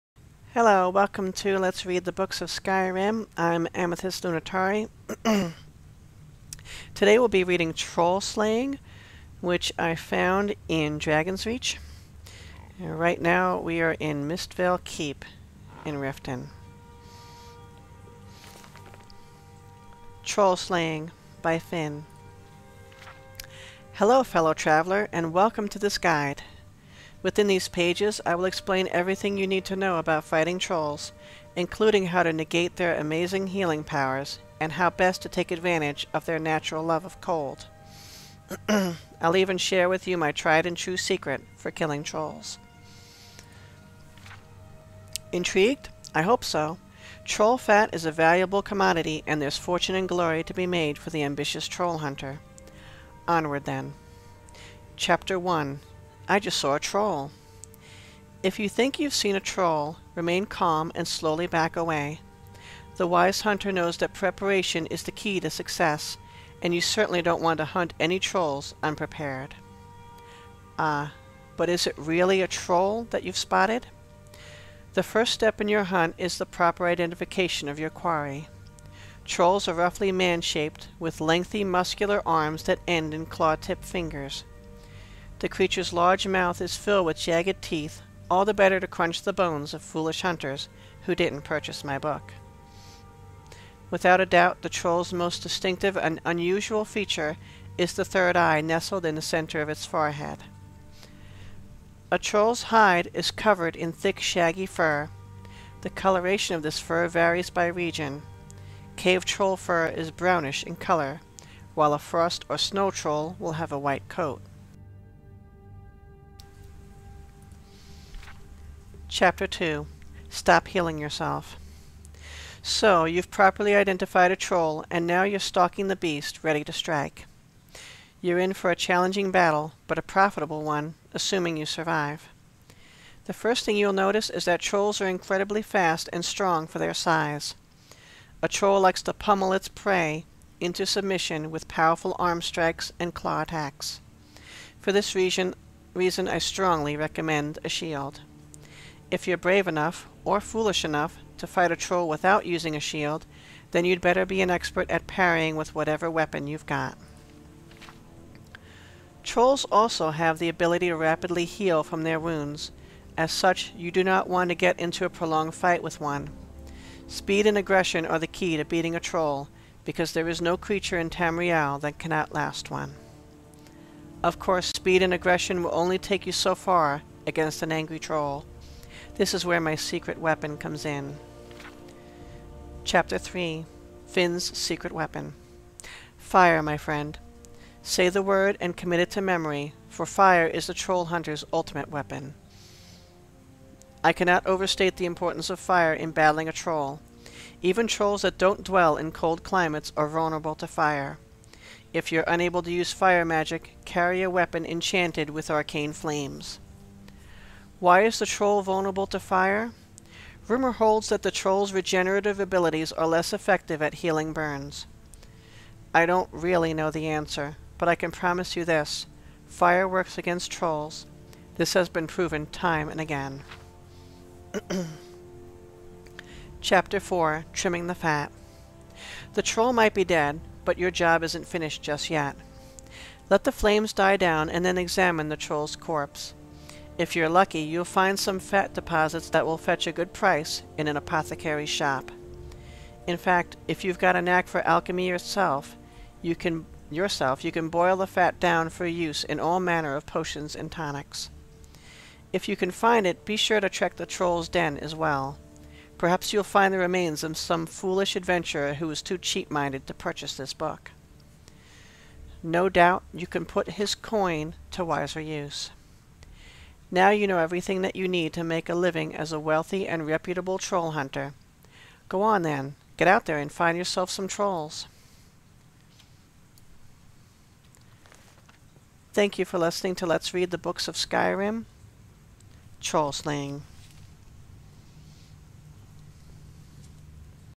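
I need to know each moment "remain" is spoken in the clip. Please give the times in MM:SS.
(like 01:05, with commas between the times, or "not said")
01:00, 04:16.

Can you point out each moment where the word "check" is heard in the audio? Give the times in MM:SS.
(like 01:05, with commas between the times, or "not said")
04:13.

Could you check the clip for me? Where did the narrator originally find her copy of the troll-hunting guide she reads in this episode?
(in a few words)
Dragon's Reach.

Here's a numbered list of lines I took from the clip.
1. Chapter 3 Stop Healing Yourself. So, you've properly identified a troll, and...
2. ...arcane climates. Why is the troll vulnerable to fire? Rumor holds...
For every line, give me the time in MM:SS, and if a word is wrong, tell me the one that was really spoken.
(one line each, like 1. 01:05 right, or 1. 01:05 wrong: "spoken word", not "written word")
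1. 01:59 wrong: "2", not "3"
2. 03:25 wrong: "flames", not "climates".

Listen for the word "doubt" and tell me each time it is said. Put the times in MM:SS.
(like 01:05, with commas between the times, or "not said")
01:34, 04:22.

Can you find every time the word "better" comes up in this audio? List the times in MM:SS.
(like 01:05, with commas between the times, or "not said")
01:28, 02:33.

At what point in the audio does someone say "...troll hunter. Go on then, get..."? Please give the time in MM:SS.
04:30.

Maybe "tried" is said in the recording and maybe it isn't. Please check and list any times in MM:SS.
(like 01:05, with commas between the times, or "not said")
00:40.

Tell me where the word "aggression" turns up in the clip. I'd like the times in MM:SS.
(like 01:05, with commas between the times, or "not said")
02:47, 02:55.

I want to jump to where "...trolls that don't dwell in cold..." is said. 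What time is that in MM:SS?
03:17.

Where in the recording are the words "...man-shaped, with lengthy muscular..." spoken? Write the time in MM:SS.
01:20.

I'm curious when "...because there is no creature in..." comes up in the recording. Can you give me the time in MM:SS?
02:49.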